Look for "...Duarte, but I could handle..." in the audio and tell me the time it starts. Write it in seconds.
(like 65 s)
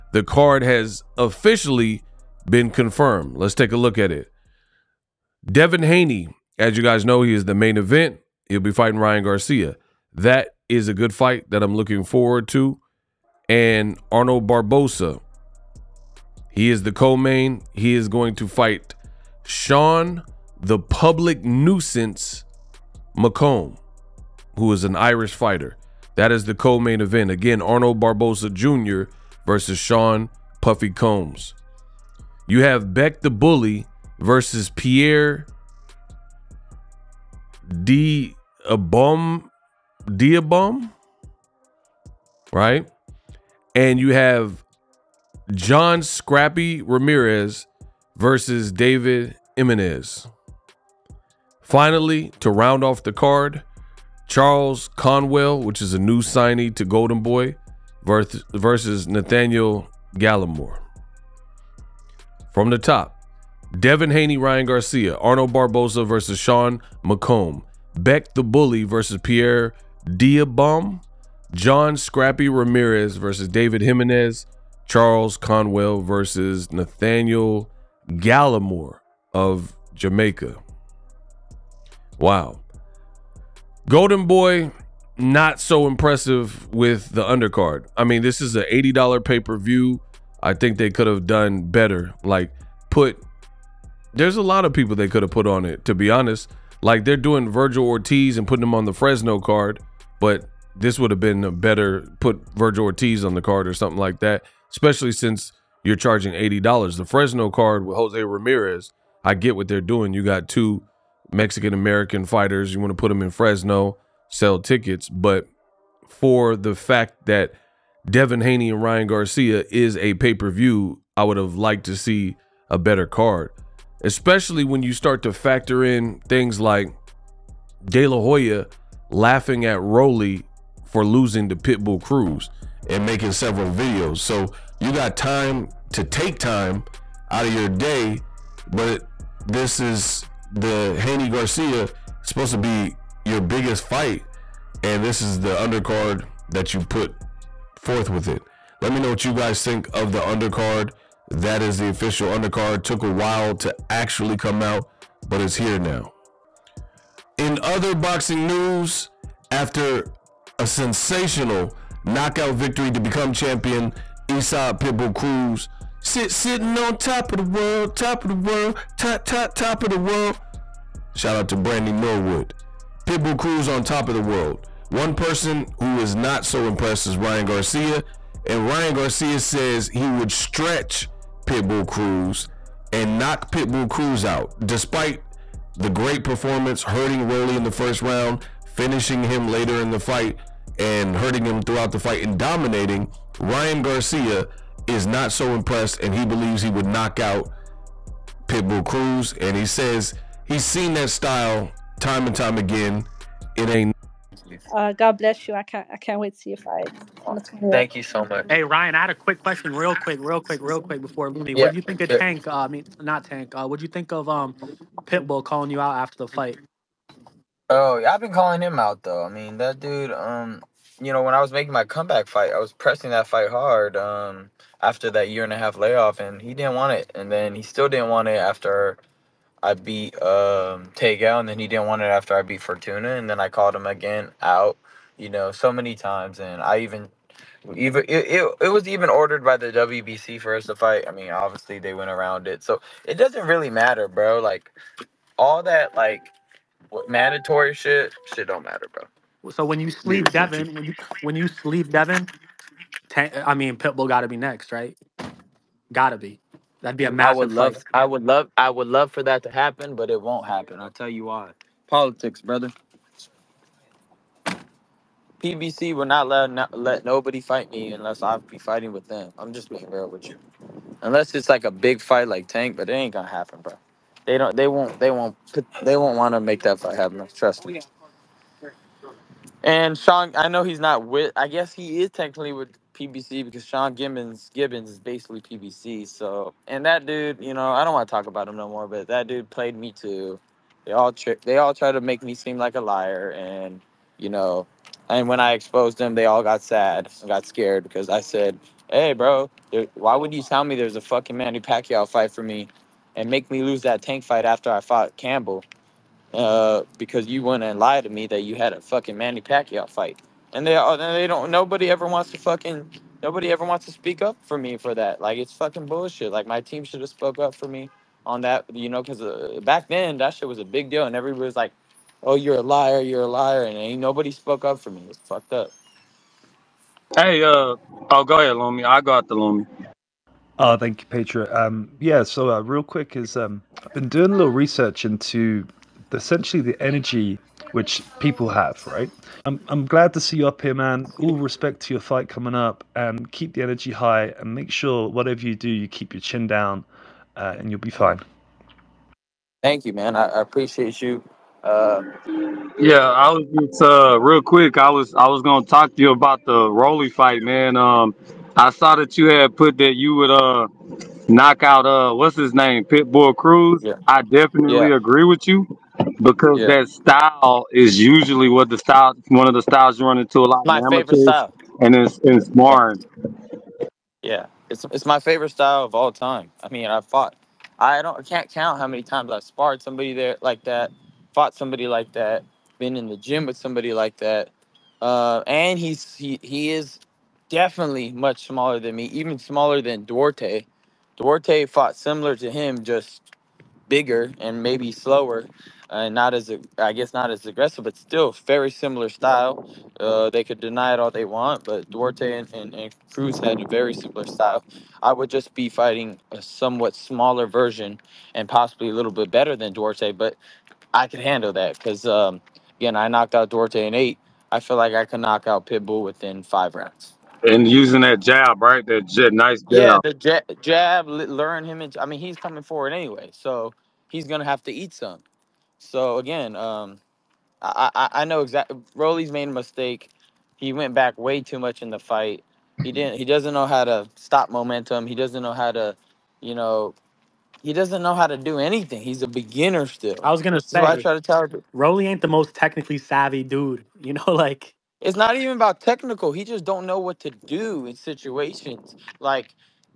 409 s.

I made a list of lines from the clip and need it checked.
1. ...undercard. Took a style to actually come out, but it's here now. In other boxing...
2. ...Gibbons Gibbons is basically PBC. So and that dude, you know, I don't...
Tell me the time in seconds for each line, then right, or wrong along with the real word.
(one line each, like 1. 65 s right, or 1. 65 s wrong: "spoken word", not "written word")
1. 152 s wrong: "while", not "style"
2. 283 s right.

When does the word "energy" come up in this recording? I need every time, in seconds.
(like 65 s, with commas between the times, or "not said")
336 s, 343 s.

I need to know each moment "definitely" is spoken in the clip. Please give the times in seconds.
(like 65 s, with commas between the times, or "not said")
364 s, 387 s.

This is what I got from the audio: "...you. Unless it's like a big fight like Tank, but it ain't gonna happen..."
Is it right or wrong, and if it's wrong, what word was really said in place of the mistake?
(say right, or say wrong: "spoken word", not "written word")
right.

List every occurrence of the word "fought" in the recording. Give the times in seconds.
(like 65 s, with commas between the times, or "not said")
304 s, 377 s, 381 s, 391 s.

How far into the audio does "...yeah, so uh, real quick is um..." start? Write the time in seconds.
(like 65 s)
331 s.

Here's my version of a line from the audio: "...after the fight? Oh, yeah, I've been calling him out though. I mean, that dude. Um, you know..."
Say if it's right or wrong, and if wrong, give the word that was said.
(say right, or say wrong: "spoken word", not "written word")
right.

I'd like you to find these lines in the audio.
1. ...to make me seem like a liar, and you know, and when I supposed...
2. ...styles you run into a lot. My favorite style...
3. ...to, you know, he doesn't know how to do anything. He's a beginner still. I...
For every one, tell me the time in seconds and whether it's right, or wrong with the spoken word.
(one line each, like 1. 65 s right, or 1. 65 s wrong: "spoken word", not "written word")
1. 291 s wrong: "exposed", not "supposed"
2. 369 s right
3. 435 s right.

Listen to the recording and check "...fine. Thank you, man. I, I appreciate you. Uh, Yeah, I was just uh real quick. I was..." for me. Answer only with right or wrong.
right.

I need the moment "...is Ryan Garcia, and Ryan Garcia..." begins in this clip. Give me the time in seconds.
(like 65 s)
177 s.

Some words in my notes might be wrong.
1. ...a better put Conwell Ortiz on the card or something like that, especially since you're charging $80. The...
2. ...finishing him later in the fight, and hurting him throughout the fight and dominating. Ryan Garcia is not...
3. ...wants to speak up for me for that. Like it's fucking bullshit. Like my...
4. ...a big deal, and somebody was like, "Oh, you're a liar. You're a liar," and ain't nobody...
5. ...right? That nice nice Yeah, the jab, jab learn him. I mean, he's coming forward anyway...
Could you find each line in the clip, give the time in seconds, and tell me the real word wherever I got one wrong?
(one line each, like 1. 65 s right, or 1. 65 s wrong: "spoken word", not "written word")
1. 101 s wrong: "Virgil", not "Conwell"
2. 188 s right
3. 313 s right
4. 320 s wrong: "everybody", not "somebody"
5. 418 s right.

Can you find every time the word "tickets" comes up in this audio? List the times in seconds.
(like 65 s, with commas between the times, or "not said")
114 s.